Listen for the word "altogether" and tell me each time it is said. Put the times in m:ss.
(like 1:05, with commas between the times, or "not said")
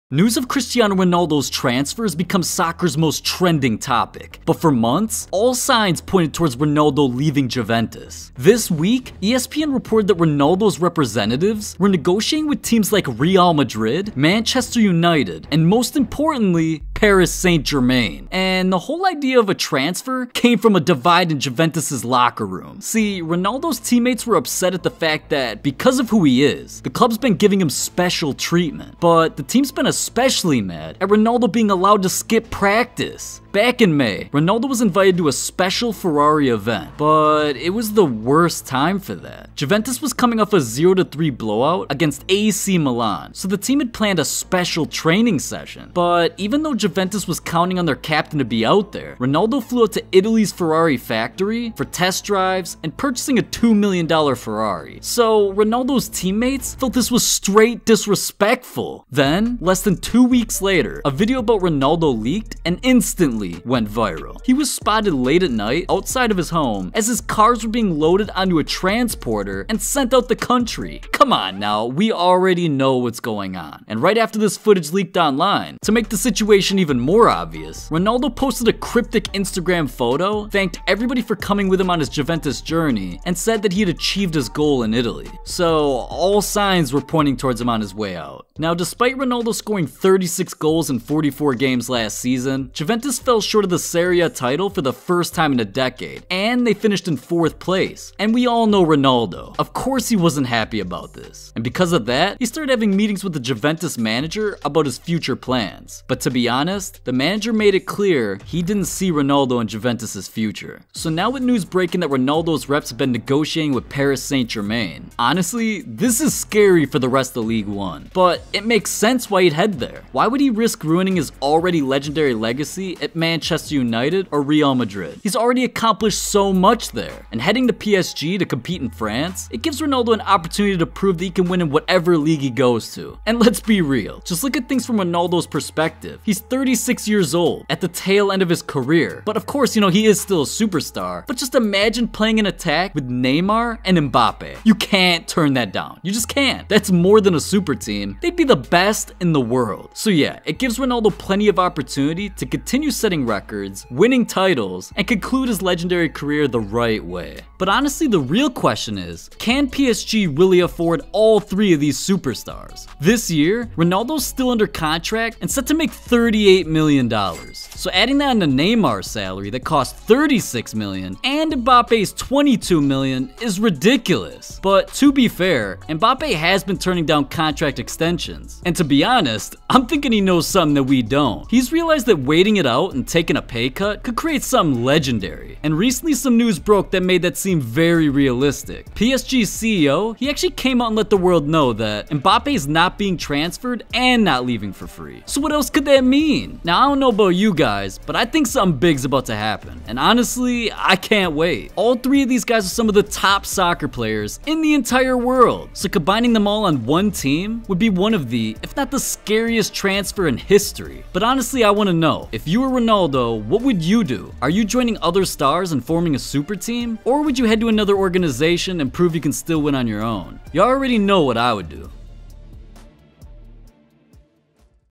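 not said.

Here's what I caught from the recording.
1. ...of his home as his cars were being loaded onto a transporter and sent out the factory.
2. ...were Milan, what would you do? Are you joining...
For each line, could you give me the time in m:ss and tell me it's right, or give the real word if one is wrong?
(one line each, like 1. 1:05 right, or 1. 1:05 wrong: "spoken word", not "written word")
1. 1:06 wrong: "country", not "factory"
2. 3:32 wrong: "Ronaldo", not "Milan".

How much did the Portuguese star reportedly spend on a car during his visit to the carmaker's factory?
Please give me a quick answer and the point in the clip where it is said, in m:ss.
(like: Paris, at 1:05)
$2 million, at 0:53.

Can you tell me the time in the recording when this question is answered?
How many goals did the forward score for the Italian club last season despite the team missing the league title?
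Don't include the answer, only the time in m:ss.
1:29.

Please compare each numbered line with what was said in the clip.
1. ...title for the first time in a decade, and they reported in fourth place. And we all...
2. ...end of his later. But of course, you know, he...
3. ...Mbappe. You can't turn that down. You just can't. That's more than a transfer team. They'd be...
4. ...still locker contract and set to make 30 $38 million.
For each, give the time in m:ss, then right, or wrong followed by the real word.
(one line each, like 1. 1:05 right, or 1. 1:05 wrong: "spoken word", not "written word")
1. 1:34 wrong: "finished", not "reported"
2. 2:18 wrong: "career", not "later"
3. 2:23 wrong: "super", not "transfer"
4. 2:44 wrong: "under", not "locker".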